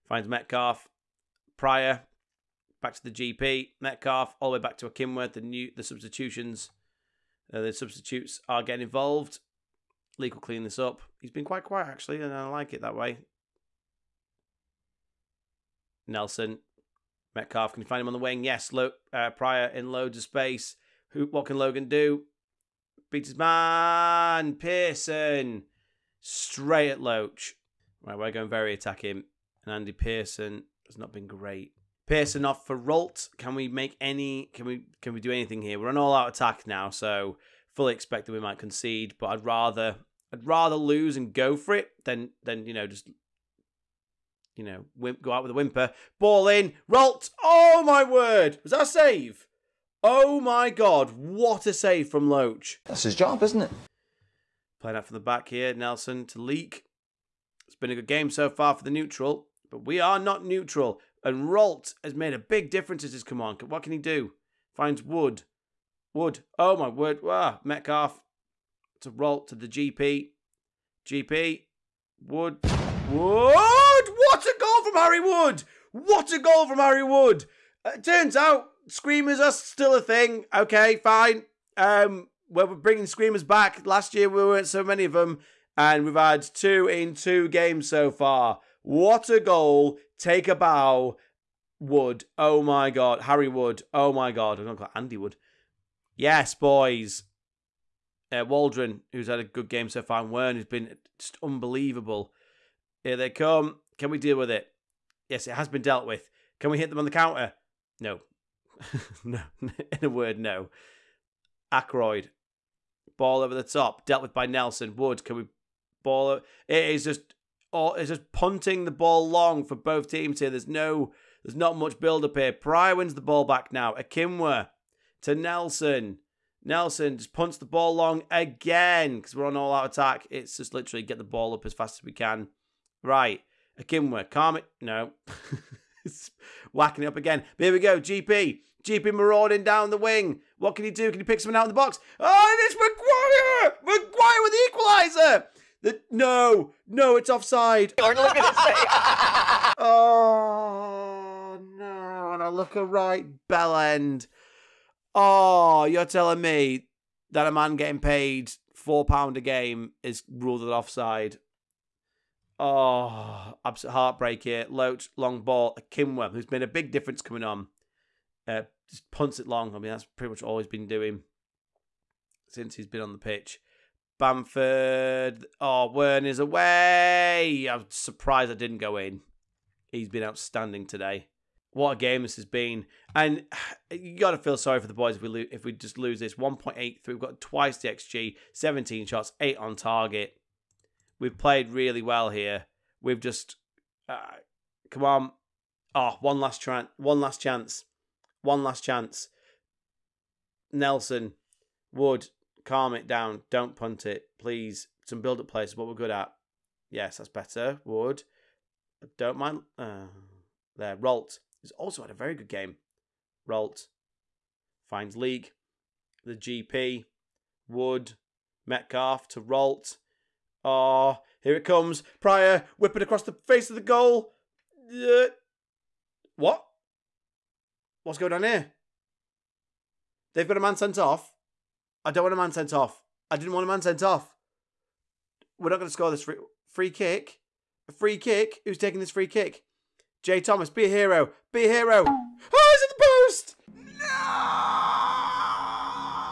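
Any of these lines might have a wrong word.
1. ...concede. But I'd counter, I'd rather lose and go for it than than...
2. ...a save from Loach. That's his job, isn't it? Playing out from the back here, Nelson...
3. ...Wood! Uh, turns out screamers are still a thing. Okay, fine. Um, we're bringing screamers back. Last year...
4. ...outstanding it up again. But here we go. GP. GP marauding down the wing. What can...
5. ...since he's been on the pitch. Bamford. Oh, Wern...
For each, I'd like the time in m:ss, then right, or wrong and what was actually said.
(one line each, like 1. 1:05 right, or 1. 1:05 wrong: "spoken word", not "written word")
1. 0:38 wrong: "rather", not "counter"
2. 0:51 right
3. 1:17 right
4. 2:16 wrong: "whacking", not "outstanding"
5. 2:52 right.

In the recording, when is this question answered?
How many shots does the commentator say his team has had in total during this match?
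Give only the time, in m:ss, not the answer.
3:08.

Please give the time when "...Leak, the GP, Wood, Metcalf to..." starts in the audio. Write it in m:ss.
3:35.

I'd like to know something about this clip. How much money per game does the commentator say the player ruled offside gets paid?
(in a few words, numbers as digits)
£4.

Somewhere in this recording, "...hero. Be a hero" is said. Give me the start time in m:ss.
4:00.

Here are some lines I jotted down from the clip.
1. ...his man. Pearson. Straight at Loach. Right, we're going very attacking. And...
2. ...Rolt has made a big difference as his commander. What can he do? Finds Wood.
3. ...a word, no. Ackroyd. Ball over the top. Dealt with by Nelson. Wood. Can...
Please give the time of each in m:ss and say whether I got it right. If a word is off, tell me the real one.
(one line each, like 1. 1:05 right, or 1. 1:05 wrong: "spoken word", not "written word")
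1. 0:23 right
2. 1:01 right
3. 1:50 right.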